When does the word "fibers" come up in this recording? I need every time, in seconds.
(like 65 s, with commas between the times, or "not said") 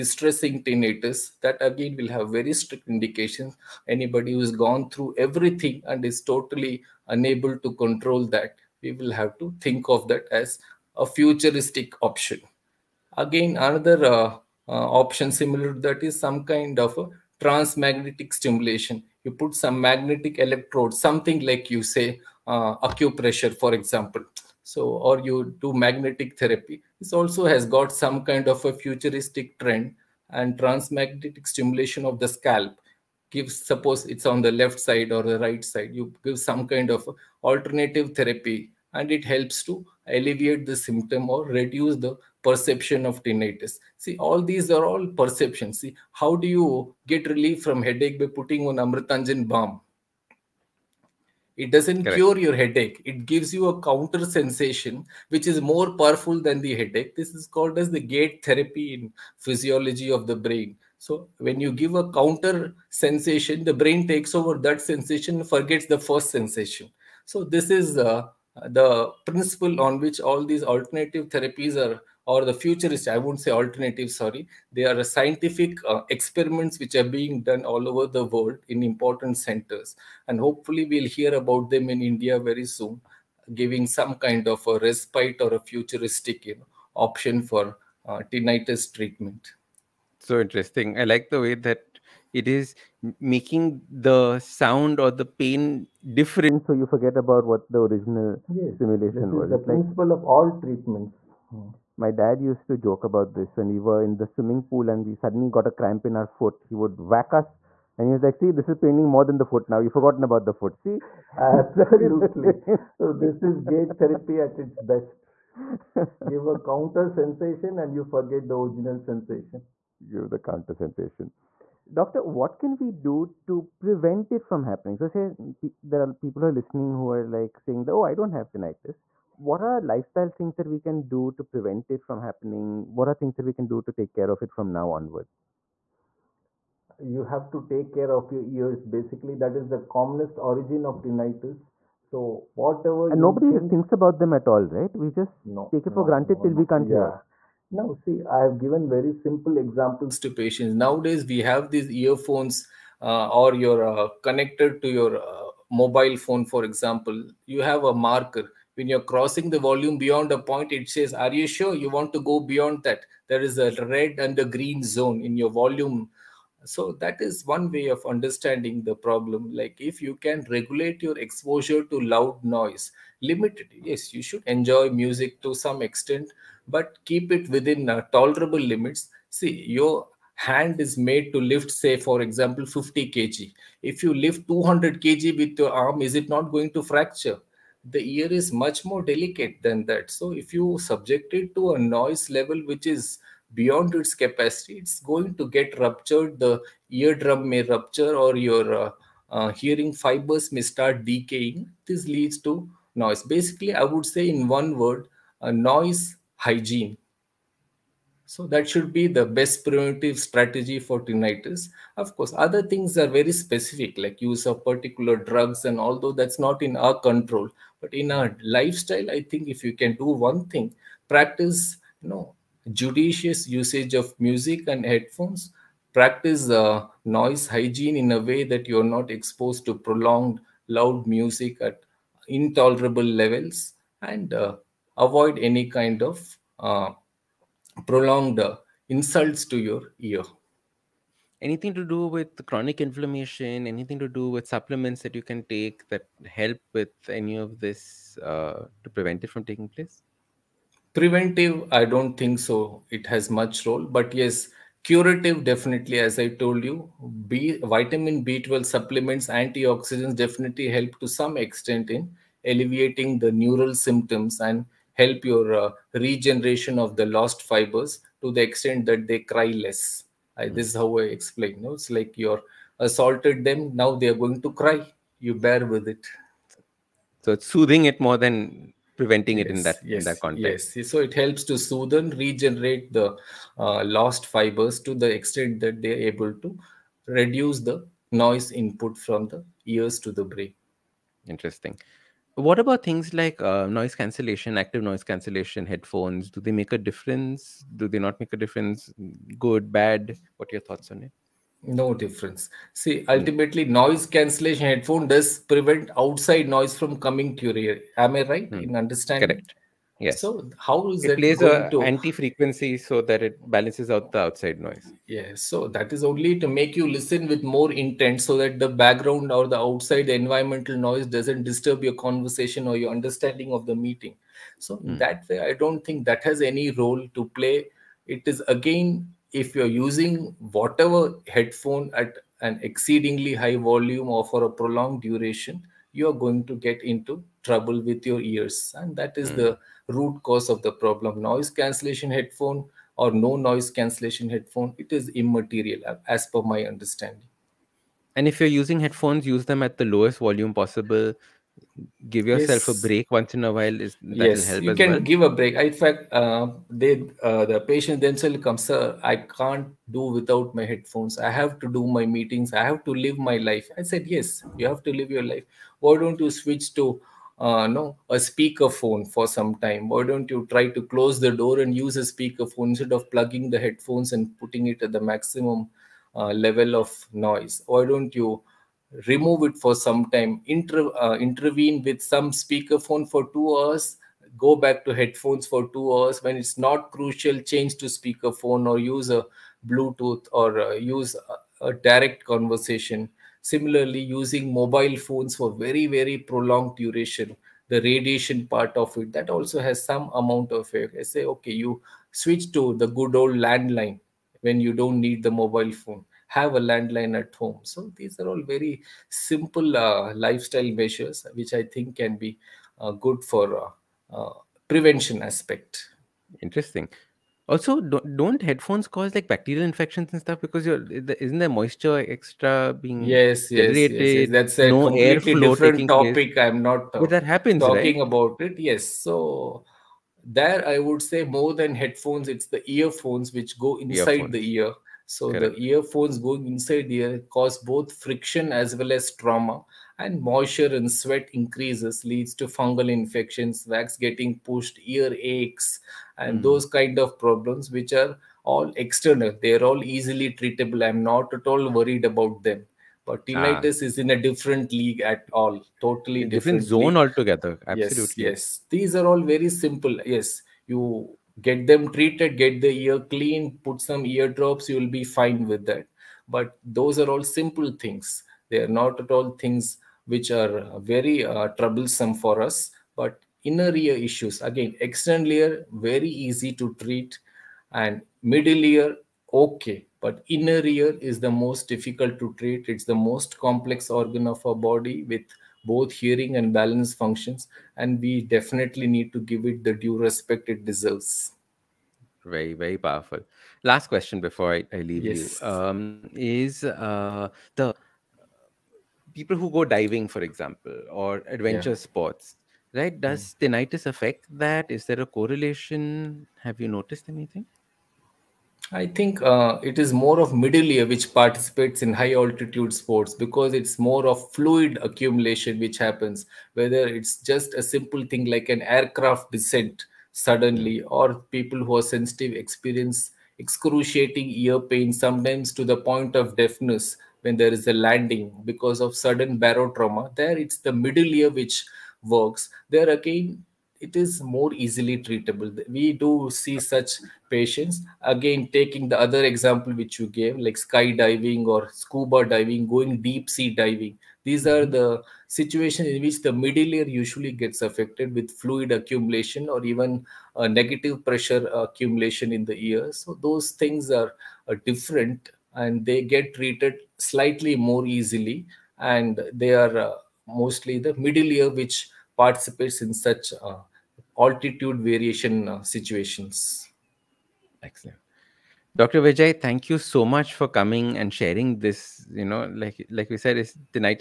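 199 s, 267 s, 284 s.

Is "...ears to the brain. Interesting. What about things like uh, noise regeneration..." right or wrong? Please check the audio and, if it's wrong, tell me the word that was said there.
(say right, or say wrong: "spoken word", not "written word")
wrong: "cancellation", not "regeneration".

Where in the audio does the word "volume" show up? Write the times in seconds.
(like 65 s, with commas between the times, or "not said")
159 s, 165 s, 333 s, 350 s.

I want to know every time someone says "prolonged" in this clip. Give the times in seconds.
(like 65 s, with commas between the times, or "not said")
229 s, 237 s, 334 s, 396 s.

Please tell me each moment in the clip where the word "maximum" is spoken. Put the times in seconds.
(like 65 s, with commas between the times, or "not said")
375 s.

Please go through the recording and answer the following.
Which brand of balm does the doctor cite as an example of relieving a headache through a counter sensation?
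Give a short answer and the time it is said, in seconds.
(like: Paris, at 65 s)
Amrutanjan, at 48 s.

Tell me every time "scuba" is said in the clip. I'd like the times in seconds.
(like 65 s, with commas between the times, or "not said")
541 s.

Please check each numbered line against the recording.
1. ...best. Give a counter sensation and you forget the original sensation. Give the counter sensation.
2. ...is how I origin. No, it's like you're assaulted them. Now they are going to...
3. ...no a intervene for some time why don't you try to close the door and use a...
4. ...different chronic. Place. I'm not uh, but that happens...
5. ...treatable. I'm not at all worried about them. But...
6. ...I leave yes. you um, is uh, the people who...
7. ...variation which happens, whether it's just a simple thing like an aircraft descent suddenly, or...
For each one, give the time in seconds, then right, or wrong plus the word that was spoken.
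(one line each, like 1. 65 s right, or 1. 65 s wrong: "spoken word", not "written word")
1. 114 s right
2. 270 s wrong: "explain", not "origin"
3. 367 s wrong: "speakerphone", not "intervene"
4. 425 s wrong: "topic", not "chronic"
5. 450 s right
6. 494 s right
7. 514 s wrong: "accumulation", not "variation".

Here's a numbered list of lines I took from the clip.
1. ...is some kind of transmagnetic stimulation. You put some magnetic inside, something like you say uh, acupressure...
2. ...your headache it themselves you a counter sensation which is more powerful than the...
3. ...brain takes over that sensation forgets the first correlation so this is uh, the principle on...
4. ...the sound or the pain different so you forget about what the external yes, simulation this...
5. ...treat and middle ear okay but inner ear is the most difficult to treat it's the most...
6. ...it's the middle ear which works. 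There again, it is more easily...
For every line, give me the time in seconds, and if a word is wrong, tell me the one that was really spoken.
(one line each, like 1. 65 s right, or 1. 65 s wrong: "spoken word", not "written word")
1. 16 s wrong: "electrode", not "inside"
2. 52 s wrong: "gives", not "themselves"
3. 63 s wrong: "sensation", not "correlation"
4. 93 s wrong: "original", not "external"
5. 476 s right
6. 530 s right.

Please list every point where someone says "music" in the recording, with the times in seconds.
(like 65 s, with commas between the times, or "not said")
174 s, 224 s, 231 s.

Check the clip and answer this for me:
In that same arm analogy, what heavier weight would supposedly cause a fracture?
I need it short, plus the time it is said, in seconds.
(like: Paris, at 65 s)
200 kg, at 184 s.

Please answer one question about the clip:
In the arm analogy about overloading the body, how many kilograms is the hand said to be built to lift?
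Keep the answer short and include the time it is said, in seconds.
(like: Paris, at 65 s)
50 kg, at 182 s.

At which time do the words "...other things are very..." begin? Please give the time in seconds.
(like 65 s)
212 s.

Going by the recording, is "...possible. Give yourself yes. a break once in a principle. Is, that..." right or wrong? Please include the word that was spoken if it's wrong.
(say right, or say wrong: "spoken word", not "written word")
wrong: "while", not "principle".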